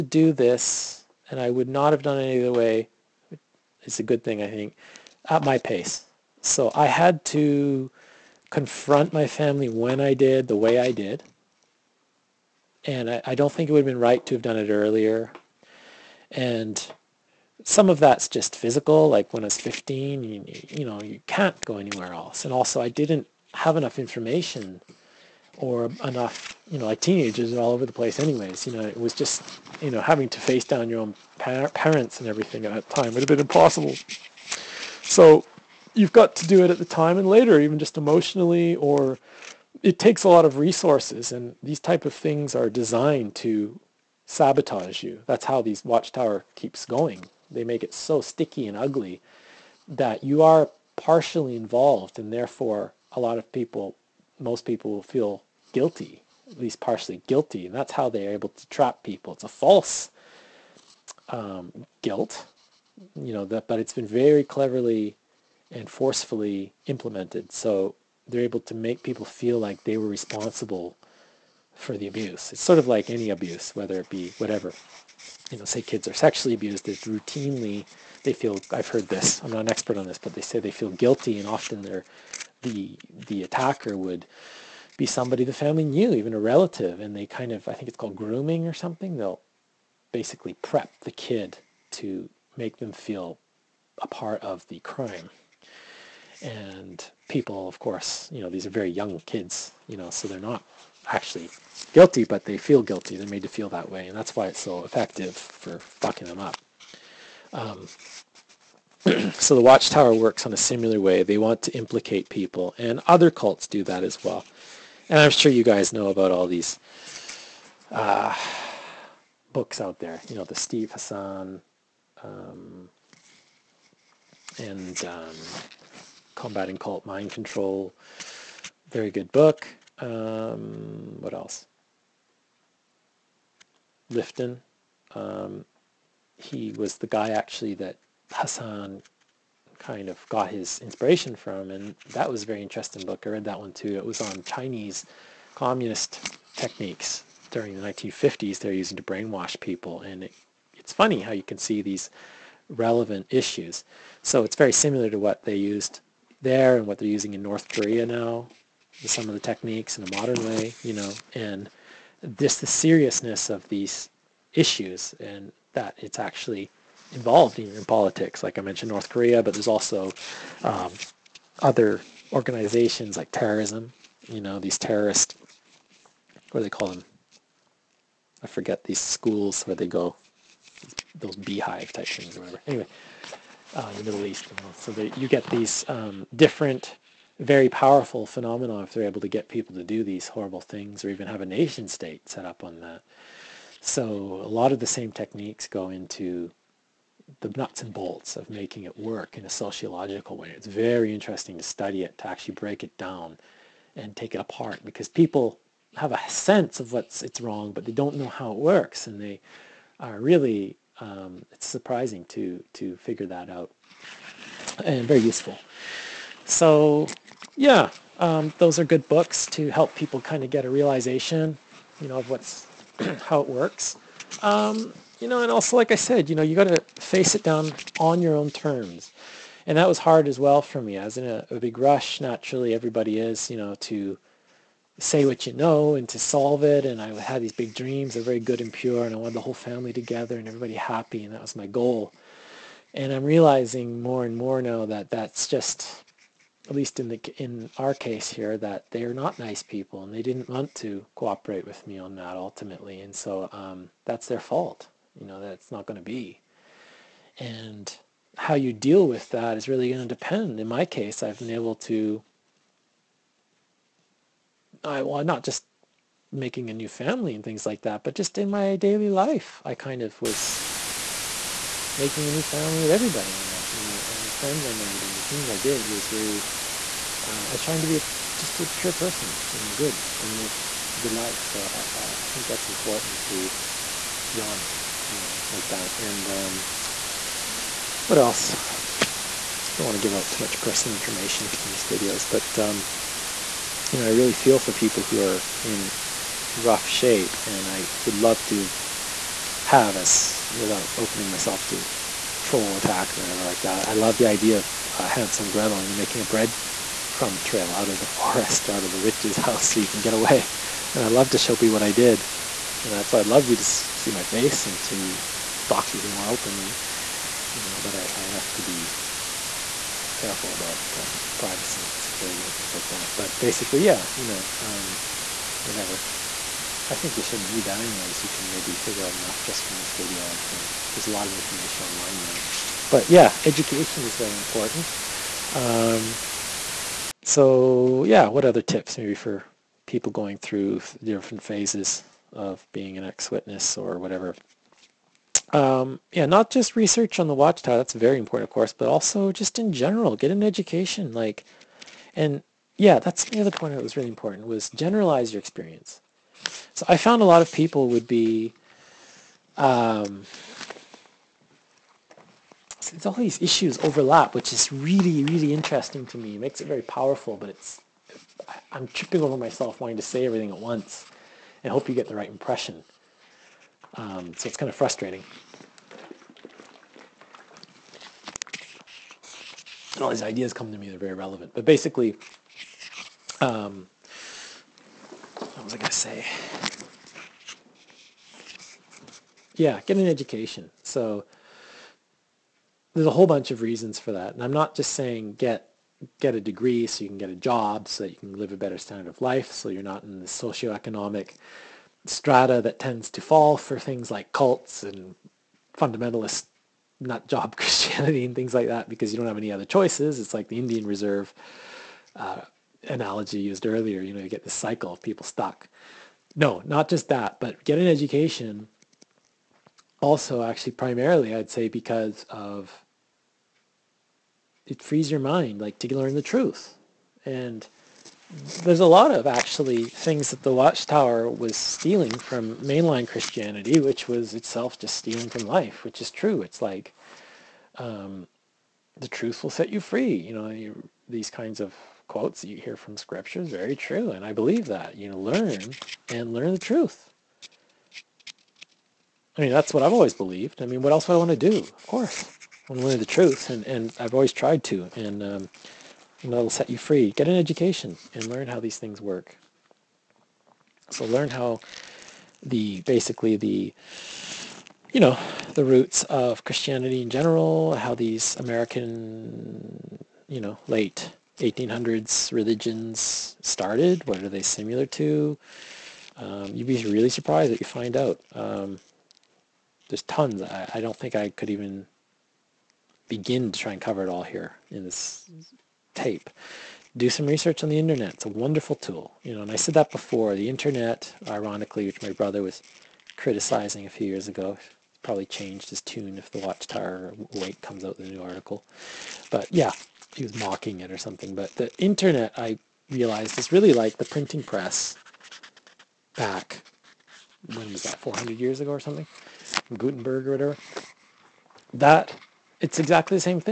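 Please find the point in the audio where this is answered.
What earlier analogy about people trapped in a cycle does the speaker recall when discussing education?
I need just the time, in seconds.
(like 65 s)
410 s.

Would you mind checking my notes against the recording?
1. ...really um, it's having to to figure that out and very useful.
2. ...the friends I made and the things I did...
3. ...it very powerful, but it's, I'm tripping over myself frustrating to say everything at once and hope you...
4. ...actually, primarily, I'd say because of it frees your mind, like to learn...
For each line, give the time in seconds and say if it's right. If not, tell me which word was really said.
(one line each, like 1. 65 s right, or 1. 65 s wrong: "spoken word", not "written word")
1. 210 s wrong: "surprising", not "having"
2. 274 s right
3. 366 s wrong: "wanting", not "frustrating"
4. 420 s right.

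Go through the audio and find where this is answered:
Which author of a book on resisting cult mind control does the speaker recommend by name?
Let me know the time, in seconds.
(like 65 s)
120 s.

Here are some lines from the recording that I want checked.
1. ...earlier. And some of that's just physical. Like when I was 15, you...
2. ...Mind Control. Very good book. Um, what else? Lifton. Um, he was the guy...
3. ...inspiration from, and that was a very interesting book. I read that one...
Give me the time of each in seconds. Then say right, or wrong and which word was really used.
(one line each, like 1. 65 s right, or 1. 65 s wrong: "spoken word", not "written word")
1. 14 s right
2. 127 s right
3. 140 s right.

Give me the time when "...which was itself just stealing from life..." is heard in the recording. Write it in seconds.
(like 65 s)
433 s.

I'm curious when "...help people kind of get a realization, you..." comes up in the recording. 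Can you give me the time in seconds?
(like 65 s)
219 s.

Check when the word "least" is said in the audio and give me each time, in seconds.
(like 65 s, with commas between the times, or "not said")
56 s, 246 s.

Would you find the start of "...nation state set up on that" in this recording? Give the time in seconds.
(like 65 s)
191 s.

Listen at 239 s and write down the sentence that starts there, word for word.
And I wanted the whole family together and everybody happy.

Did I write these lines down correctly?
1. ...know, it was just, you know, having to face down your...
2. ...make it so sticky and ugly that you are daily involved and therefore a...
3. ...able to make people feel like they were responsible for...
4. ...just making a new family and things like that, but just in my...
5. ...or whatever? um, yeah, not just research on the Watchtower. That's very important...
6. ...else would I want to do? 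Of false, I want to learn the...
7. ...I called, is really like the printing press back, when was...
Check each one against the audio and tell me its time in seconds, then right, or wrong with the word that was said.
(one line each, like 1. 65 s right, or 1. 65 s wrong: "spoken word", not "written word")
1. 28 s right
2. 47 s wrong: "partially", not "daily"
3. 68 s right
4. 265 s right
5. 343 s right
6. 450 s wrong: "course", not "false"
7. 502 s wrong: "realized", not "called".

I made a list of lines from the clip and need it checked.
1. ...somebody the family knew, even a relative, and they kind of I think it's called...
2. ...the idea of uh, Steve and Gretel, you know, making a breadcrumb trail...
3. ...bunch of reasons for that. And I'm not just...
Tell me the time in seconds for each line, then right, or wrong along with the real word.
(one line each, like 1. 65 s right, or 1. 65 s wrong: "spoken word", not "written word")
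1. 85 s right
2. 304 s wrong: "Hansel", not "Steve"
3. 393 s right.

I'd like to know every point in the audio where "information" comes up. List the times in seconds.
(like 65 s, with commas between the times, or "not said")
23 s, 290 s, 331 s.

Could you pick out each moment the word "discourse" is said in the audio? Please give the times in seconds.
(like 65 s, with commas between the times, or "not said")
not said.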